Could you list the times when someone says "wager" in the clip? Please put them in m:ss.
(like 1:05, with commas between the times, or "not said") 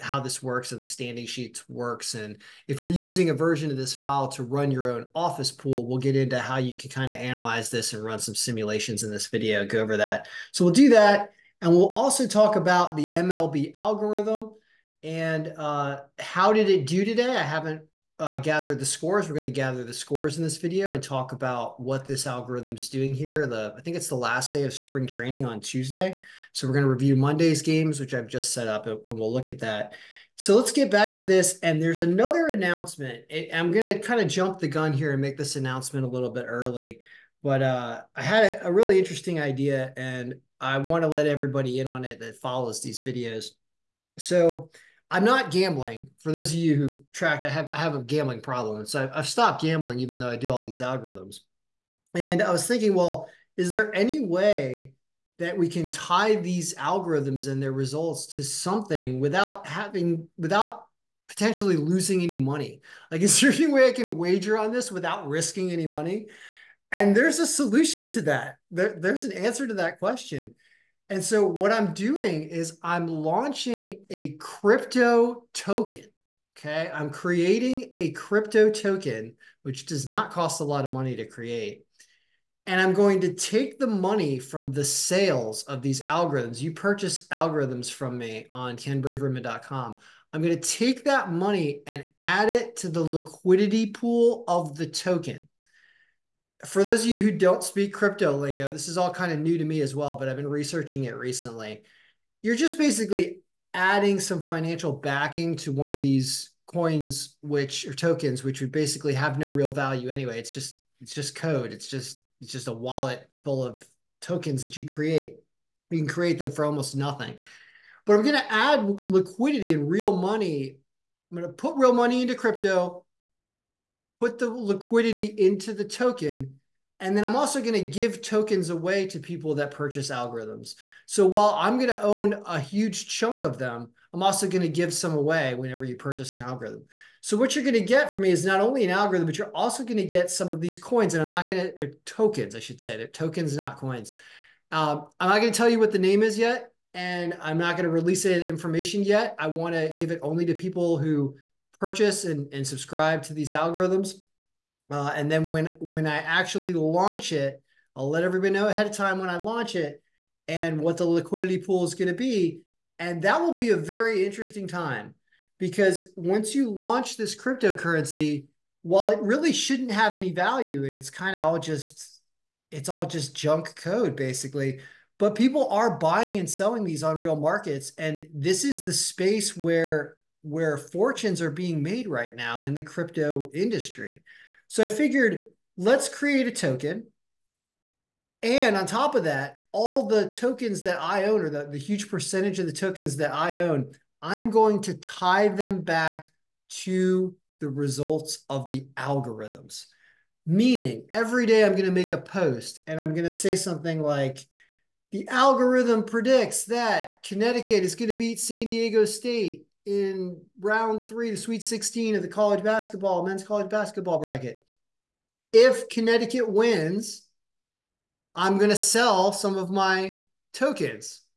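1:04.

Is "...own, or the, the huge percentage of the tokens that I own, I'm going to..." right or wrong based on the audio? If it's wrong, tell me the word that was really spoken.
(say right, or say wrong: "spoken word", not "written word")
right.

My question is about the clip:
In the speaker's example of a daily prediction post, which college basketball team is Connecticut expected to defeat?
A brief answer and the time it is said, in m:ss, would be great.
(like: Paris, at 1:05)
San Diego State, at 3:28.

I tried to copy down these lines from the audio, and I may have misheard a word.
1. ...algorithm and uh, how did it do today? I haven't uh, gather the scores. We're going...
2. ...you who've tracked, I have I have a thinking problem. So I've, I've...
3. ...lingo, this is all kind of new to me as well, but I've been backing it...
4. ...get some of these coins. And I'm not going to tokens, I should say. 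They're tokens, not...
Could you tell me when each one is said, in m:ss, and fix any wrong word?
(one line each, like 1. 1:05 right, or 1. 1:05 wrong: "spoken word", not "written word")
1. 0:13 right
2. 0:46 wrong: "gambling", not "thinking"
3. 1:38 wrong: "researching", not "backing"
4. 2:20 right.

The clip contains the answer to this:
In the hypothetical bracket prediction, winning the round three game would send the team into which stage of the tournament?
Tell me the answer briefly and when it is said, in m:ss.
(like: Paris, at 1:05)
Sweet 16, at 3:31.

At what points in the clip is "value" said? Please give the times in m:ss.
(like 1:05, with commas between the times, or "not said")
1:49, 2:50.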